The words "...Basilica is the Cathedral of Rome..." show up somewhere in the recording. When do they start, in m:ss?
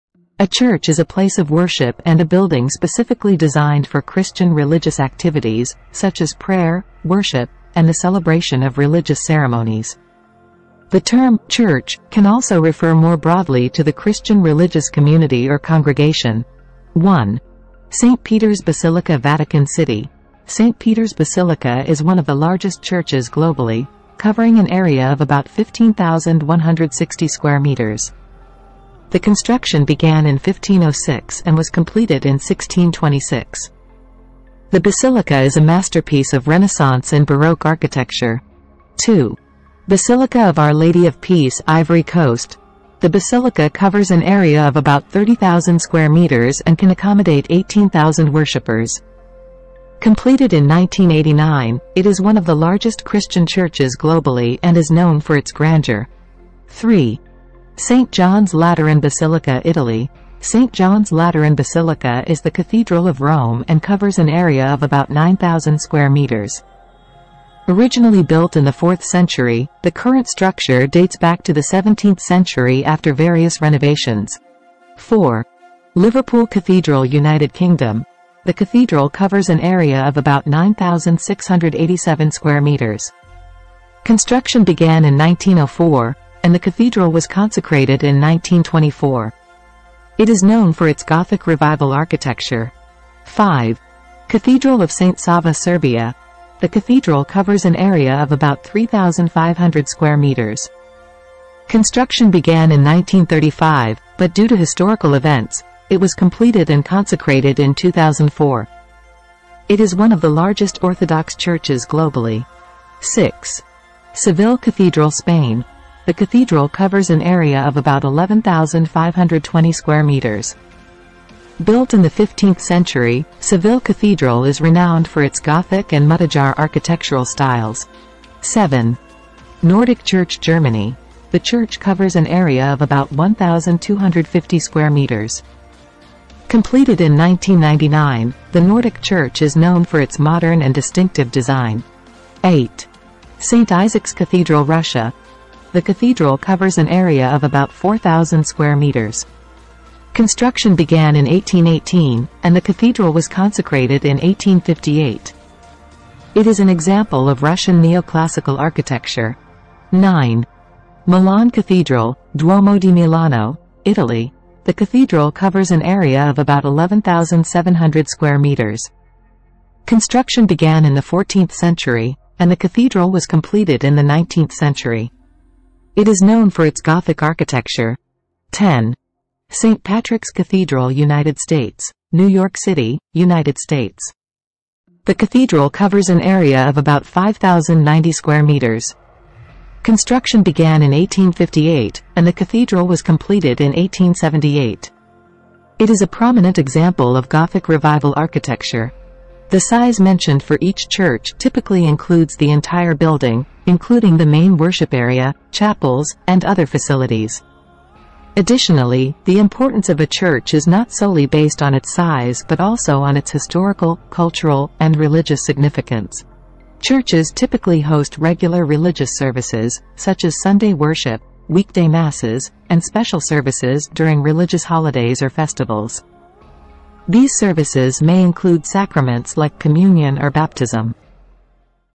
1:01.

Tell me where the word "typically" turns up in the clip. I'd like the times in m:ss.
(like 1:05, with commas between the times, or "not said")
3:21, 3:37.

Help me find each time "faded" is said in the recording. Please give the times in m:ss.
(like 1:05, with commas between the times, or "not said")
not said.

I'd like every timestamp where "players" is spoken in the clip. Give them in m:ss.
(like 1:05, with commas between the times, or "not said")
not said.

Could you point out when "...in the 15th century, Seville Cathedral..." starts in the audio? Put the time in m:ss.
2:01.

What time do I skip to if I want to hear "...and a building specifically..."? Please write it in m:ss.
0:02.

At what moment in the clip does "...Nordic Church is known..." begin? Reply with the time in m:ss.
2:18.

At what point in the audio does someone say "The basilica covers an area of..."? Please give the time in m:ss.
0:43.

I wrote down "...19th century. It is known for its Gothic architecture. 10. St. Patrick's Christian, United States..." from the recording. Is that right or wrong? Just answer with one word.
wrong.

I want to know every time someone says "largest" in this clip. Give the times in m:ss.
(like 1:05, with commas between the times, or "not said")
0:22, 0:52, 1:50.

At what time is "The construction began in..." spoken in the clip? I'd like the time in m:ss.
0:29.